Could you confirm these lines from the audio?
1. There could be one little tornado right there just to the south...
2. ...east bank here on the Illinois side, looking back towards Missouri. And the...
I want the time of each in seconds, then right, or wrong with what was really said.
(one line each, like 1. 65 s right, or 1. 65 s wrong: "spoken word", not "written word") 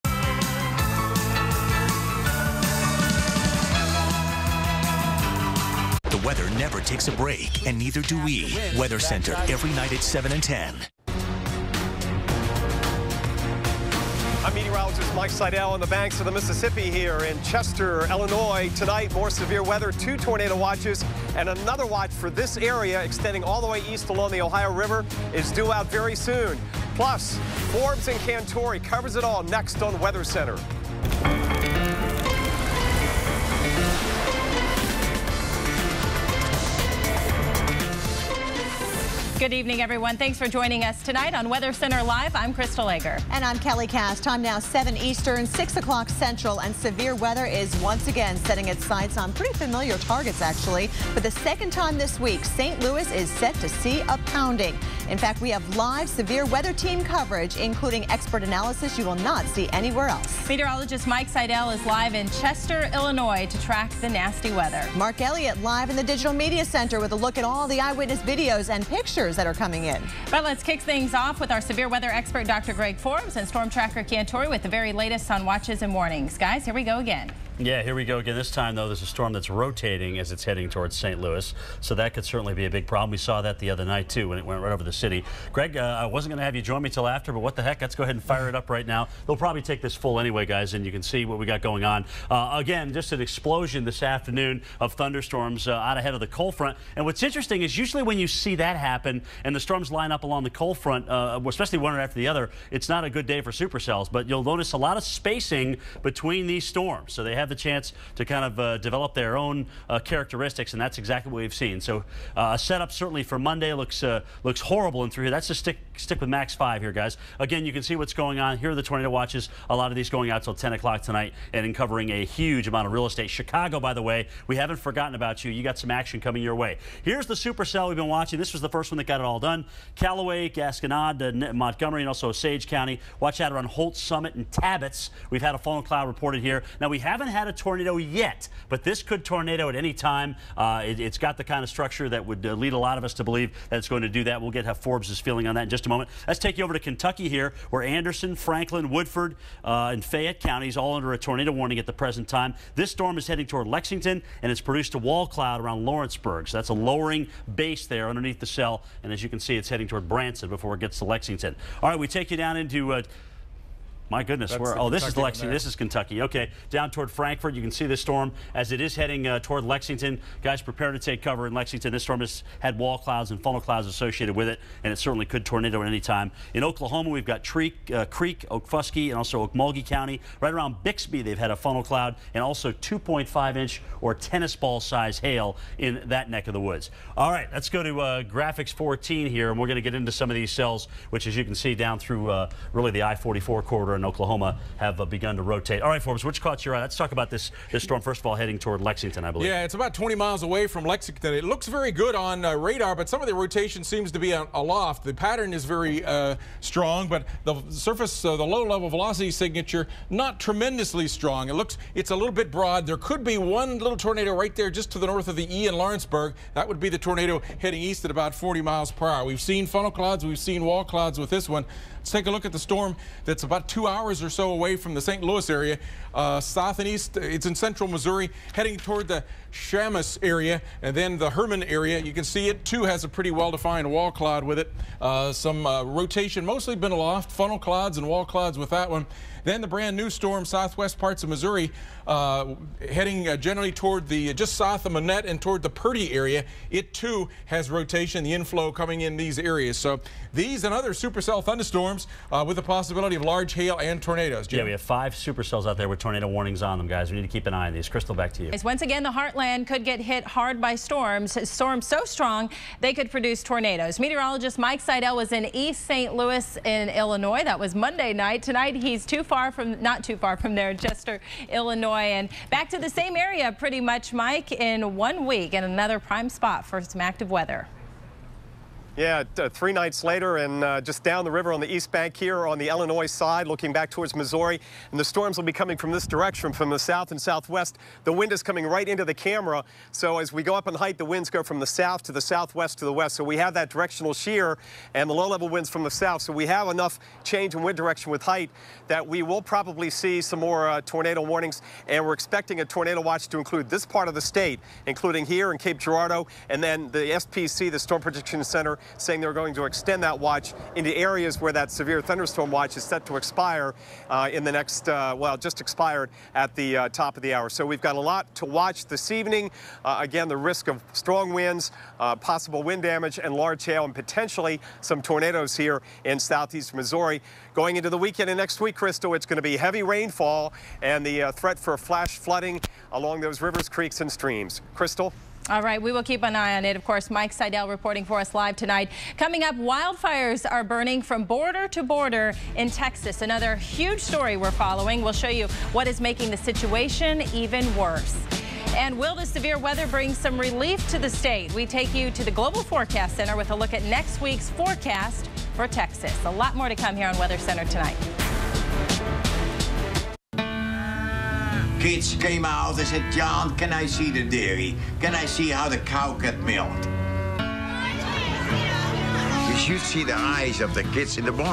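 1. 212 s wrong: "north", not "south"
2. 281 s right.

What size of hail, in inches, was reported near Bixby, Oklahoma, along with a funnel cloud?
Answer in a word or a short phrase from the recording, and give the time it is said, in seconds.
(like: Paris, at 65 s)
2.5 inches, at 182 s.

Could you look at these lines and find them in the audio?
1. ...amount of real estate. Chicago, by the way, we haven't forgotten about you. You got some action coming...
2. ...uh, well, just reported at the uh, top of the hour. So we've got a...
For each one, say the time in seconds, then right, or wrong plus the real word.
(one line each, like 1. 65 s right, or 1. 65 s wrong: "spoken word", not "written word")
1. 122 s right
2. 314 s wrong: "expired", not "reported".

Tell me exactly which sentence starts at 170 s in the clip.
Guys, prepare to take cover in Lexington.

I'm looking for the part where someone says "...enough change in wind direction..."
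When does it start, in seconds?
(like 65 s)
296 s.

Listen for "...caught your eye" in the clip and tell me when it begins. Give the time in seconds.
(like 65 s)
196 s.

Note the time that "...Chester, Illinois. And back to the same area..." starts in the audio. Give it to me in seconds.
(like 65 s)
270 s.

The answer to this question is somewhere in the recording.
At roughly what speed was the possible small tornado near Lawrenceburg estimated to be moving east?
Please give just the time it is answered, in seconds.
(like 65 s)
218 s.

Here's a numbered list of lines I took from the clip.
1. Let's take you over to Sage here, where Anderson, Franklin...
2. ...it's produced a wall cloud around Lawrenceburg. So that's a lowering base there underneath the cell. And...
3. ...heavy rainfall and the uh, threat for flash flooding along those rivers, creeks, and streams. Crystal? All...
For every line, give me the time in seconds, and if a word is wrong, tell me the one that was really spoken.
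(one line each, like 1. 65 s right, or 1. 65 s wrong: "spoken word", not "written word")
1. 146 s wrong: "Kentucky", not "Sage"
2. 154 s right
3. 329 s right.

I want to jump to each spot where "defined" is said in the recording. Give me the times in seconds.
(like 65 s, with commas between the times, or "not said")
233 s.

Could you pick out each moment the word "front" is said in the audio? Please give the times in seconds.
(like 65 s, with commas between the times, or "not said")
96 s, 100 s.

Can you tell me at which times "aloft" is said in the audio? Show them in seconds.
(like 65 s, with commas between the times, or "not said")
204 s, 236 s.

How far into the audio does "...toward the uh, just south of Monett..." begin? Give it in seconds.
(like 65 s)
243 s.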